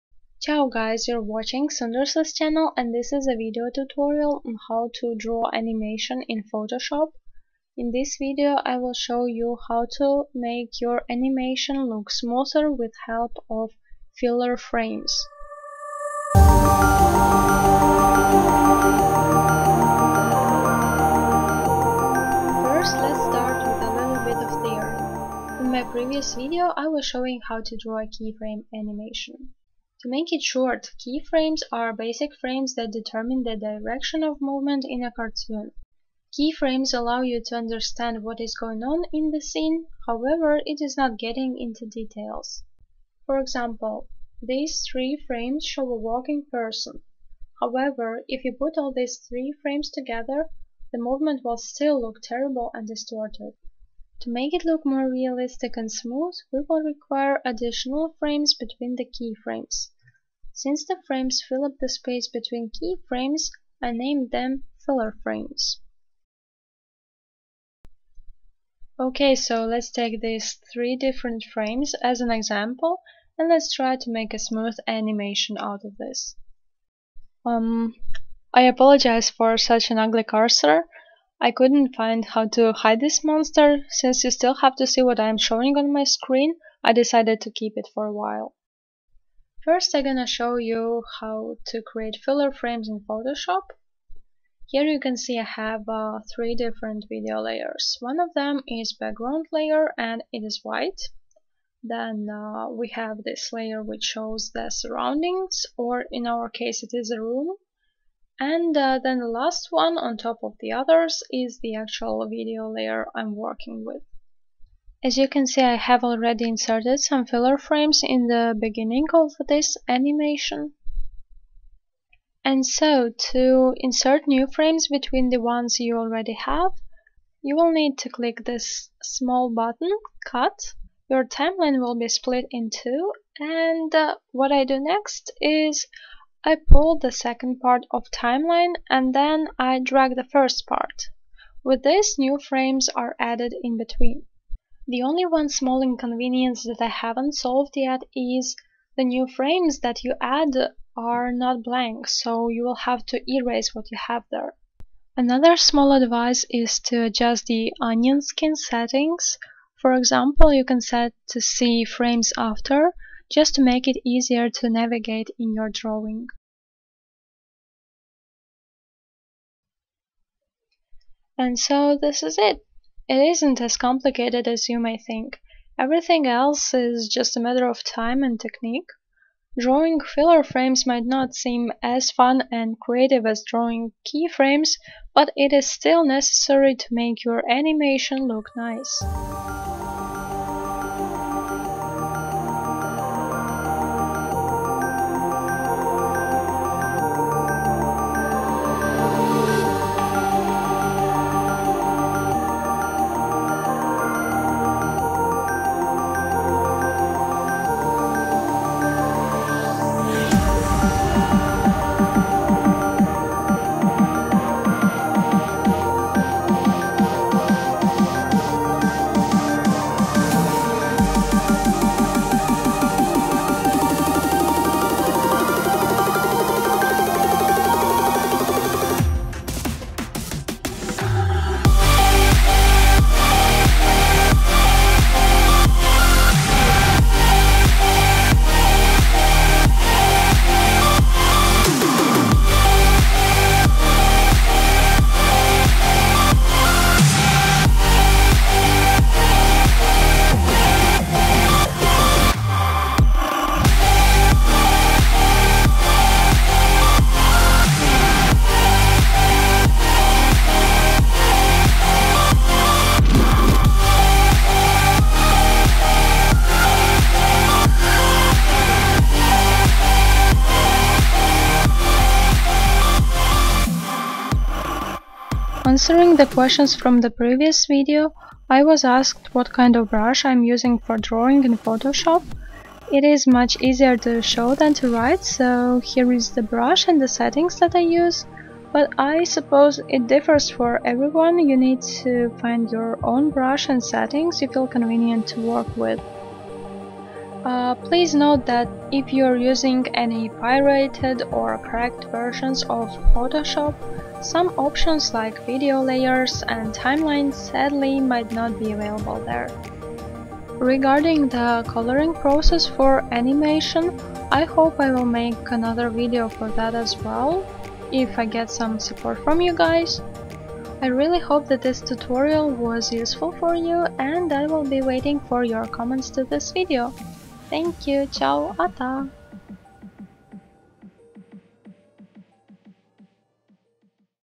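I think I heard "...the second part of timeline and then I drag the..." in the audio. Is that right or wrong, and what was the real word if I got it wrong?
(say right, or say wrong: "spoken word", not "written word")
right.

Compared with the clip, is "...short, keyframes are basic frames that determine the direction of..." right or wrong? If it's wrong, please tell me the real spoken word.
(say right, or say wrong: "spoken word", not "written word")
right.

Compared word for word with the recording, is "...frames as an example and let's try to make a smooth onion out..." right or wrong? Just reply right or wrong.
wrong.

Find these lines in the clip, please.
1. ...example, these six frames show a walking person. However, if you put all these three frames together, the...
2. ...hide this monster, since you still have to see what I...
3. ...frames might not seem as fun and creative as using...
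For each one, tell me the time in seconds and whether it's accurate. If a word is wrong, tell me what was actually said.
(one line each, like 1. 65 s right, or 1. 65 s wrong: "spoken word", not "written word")
1. 43 s wrong: "three", not "six"
2. 82 s right
3. 180 s wrong: "drawing", not "using".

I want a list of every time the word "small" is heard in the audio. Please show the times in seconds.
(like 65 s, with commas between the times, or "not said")
129 s, 145 s, 155 s.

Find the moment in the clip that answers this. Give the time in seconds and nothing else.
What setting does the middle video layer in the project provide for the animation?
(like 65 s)
107 s.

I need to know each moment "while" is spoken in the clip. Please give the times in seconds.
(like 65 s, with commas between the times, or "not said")
88 s.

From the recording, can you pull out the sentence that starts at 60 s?
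Since the frames fill up the space between keyframes, I named them filler frames.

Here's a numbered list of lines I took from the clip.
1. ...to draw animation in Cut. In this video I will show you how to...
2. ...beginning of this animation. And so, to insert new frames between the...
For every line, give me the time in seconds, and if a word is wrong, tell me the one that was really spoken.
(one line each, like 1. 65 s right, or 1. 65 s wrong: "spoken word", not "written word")
1. 4 s wrong: "Photoshop", not "Cut"
2. 118 s right.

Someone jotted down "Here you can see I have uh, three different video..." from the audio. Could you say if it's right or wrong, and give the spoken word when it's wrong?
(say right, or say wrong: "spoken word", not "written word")
right.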